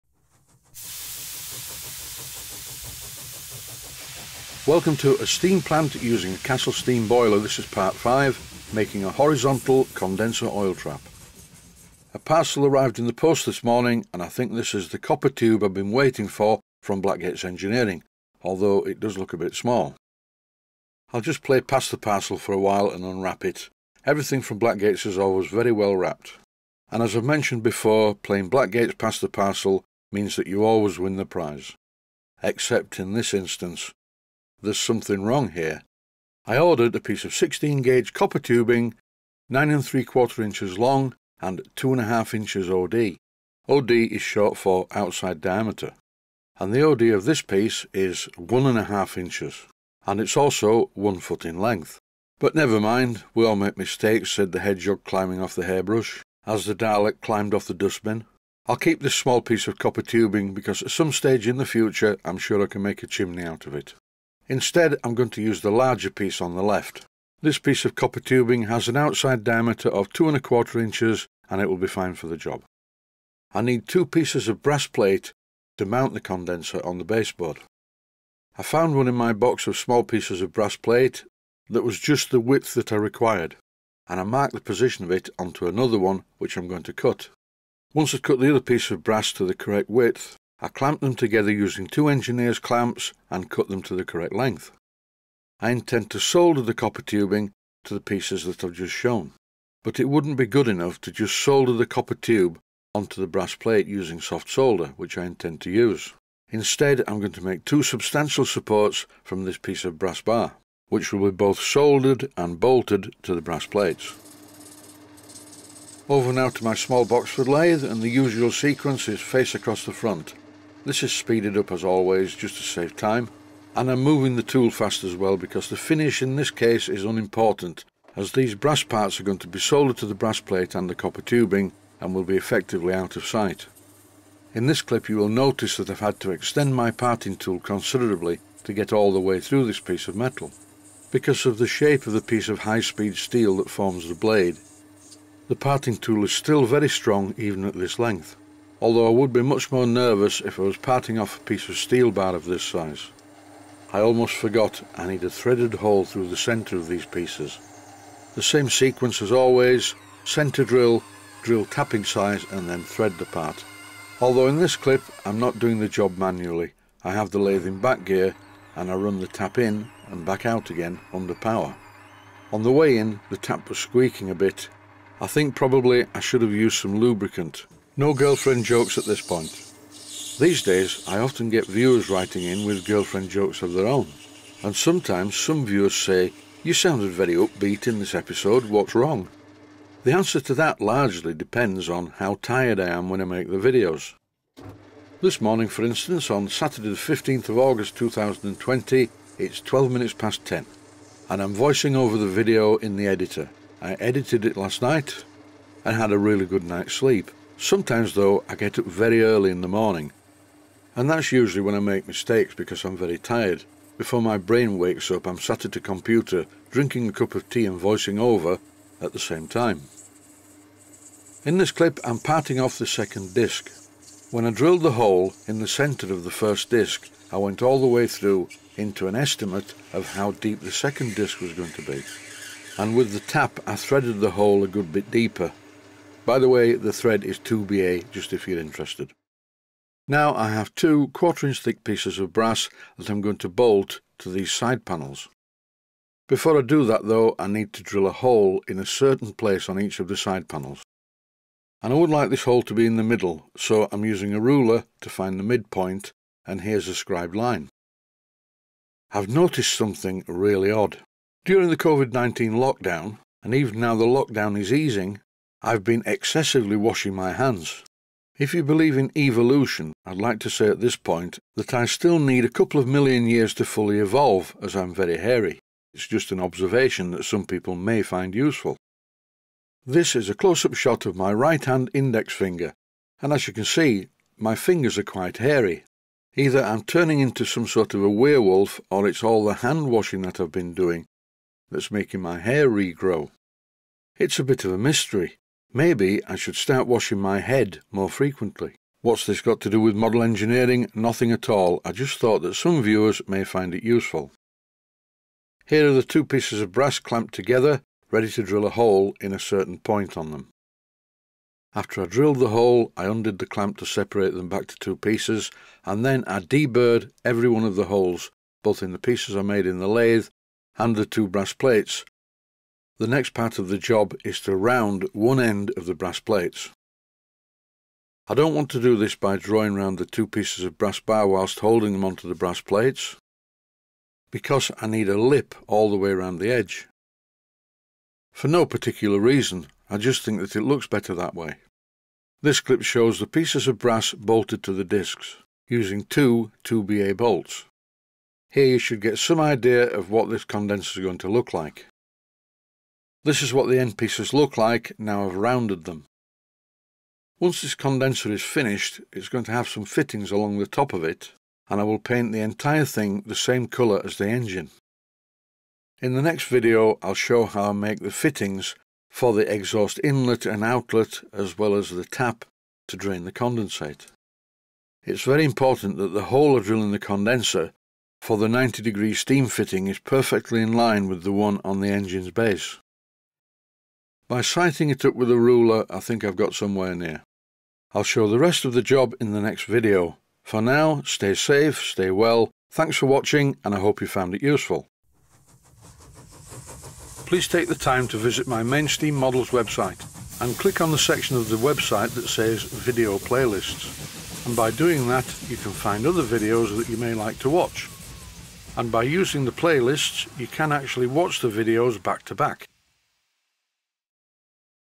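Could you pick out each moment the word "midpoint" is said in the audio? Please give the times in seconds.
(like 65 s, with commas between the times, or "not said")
255 s.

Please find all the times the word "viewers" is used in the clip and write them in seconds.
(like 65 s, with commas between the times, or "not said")
181 s, 185 s, 302 s.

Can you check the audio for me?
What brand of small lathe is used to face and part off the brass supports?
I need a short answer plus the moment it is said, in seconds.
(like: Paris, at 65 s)
Boxford, at 117 s.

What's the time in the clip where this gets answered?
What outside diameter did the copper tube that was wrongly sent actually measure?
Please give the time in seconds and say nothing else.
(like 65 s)
48 s.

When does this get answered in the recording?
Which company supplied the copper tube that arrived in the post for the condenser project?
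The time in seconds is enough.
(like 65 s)
17 s.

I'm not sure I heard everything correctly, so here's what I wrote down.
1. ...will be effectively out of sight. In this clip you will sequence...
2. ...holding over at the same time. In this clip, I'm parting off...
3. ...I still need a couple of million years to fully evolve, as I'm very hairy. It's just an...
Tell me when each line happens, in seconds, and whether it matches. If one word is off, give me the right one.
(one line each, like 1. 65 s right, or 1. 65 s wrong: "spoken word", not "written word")
1. 132 s wrong: "notice", not "sequence"
2. 217 s wrong: "voicing", not "holding"
3. 271 s right.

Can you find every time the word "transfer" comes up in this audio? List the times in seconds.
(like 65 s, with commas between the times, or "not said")
not said.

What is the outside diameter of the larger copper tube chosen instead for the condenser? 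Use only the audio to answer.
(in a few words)
2 1/4 inches.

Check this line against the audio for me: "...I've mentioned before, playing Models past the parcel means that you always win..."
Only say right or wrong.
wrong.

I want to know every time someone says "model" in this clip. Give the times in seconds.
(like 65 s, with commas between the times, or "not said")
299 s, 399 s.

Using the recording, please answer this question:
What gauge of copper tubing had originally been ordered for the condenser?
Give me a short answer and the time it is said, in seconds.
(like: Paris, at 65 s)
16 gauge, at 37 s.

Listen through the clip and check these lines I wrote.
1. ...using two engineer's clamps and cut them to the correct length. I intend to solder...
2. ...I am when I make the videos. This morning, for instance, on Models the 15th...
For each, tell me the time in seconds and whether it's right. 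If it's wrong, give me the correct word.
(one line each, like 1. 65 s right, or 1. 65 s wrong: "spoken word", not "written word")
1. 91 s right
2. 192 s wrong: "Saturday", not "Models".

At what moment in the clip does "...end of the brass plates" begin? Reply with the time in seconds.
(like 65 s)
325 s.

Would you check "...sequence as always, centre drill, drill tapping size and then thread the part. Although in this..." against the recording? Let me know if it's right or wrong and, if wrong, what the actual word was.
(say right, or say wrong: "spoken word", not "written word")
right.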